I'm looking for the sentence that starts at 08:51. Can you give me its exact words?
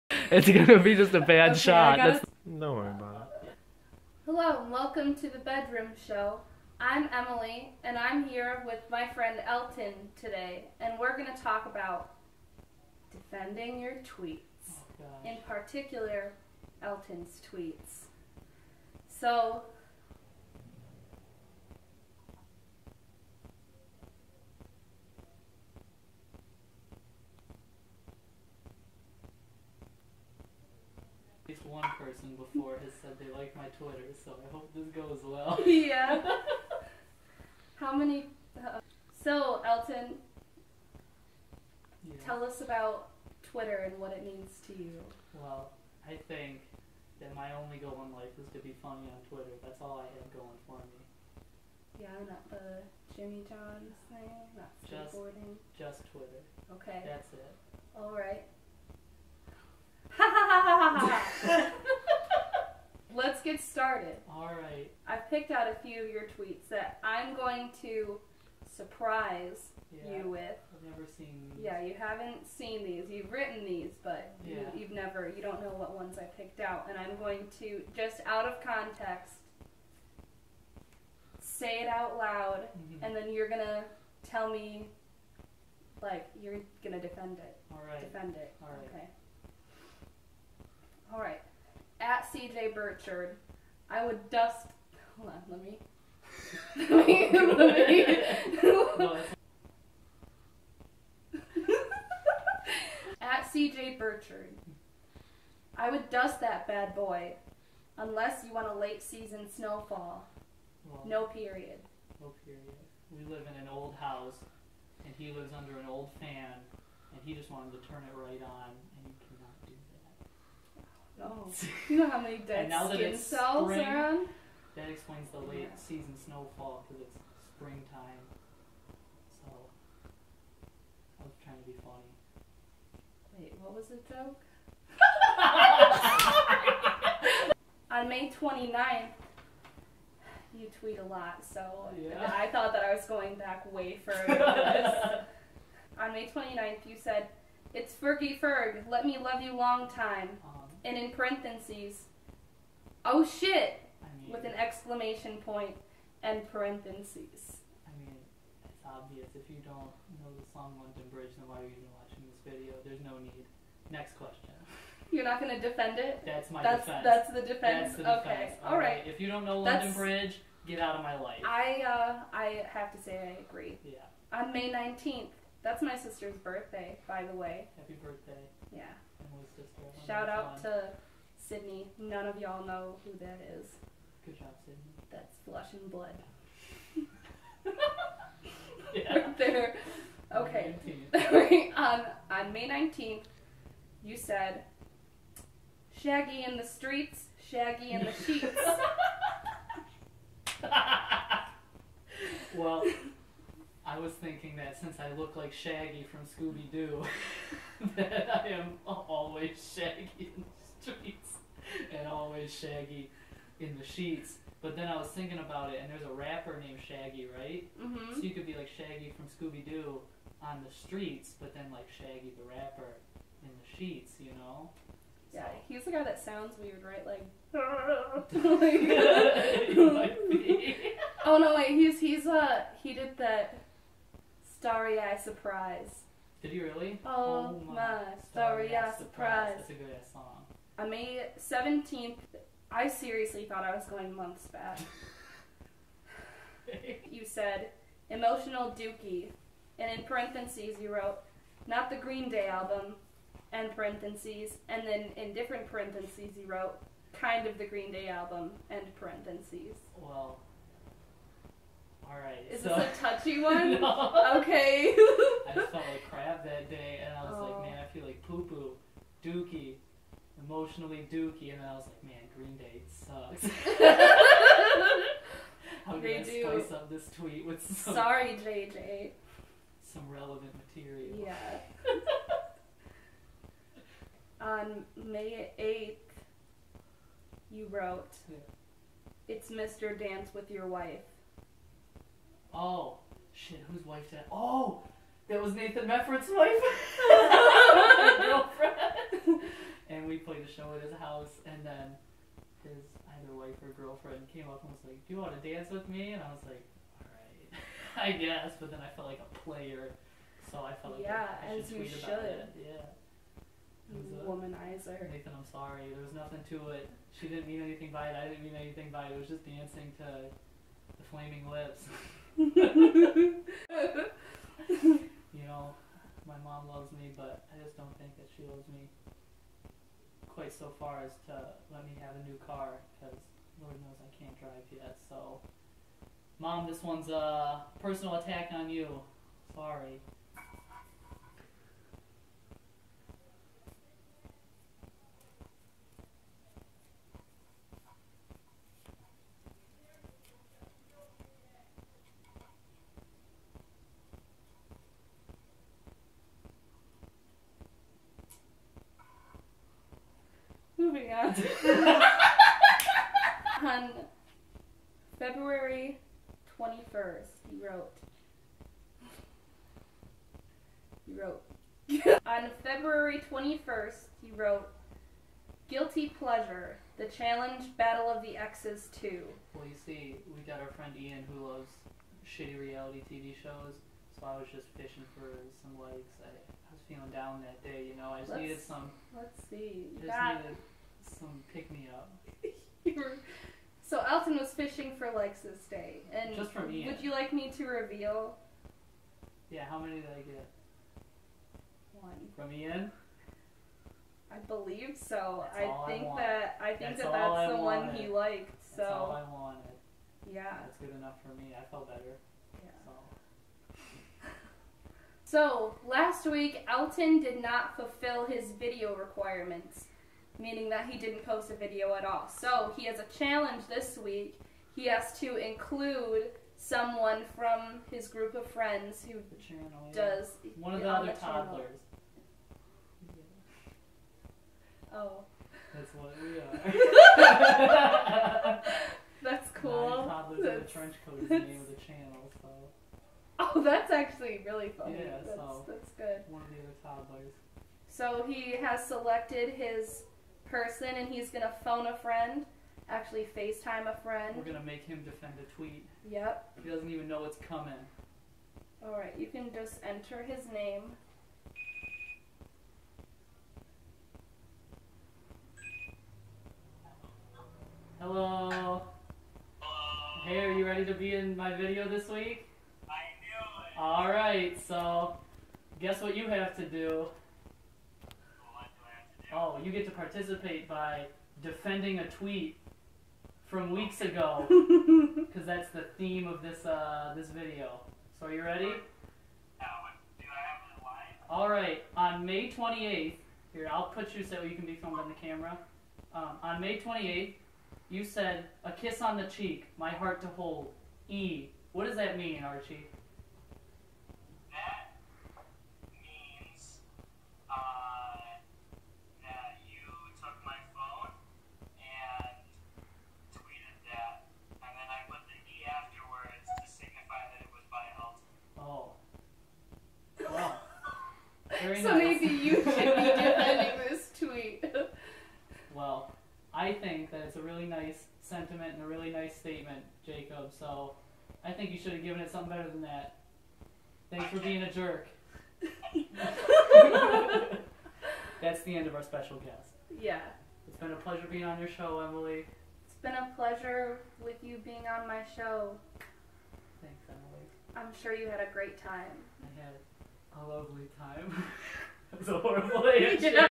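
think you should have given it something better than that.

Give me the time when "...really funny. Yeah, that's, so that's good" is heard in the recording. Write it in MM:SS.
07:24.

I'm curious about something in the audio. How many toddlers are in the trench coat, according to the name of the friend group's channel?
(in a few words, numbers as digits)
9.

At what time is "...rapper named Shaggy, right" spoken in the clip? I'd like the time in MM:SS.
03:36.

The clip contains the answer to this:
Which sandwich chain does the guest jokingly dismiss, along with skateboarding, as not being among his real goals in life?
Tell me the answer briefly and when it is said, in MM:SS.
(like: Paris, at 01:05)
Jimmy John's, at 00:53.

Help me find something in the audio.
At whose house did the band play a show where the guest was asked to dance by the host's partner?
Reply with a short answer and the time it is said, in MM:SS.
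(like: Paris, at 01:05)
Nathan Mefford, at 04:55.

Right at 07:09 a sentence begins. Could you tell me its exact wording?
does one of the other the toddlers.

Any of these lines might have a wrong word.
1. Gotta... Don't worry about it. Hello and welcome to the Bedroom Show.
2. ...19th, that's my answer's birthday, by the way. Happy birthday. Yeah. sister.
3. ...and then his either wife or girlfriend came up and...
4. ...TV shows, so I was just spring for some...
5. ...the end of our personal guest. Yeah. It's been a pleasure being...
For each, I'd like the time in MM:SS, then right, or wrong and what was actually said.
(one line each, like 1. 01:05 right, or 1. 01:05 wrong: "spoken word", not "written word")
1. 00:01 right
2. 02:54 wrong: "sister", not "answer"
3. 05:01 right
4. 06:23 wrong: "fishing", not "spring"
5. 08:58 wrong: "special", not "personal".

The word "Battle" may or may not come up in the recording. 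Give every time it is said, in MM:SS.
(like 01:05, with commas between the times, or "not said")
06:17.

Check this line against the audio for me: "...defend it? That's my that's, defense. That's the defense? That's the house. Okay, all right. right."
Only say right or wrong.
wrong.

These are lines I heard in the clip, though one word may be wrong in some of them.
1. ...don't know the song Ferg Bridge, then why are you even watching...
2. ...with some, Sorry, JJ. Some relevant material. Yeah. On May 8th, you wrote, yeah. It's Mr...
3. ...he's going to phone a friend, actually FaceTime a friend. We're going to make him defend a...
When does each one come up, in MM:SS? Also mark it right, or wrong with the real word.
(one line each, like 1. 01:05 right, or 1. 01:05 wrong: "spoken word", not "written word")
1. 02:39 wrong: "London", not "Ferg"
2. 04:37 right
3. 07:31 right.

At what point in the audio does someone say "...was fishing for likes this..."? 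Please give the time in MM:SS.
06:34.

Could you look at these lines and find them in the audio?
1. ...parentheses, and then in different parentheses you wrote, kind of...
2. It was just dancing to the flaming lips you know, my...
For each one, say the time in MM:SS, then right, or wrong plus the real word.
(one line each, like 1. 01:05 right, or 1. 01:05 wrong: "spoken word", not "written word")
1. 04:13 right
2. 05:19 right.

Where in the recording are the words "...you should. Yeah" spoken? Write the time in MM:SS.
05:11.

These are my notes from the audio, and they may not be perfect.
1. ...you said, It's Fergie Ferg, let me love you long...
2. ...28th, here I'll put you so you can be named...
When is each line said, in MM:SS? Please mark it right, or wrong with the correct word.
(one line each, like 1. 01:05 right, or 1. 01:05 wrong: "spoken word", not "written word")
1. 02:26 right
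2. 08:12 wrong: "filmed", not "named".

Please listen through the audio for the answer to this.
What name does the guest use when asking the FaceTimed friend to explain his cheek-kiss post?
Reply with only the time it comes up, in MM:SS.
08:22.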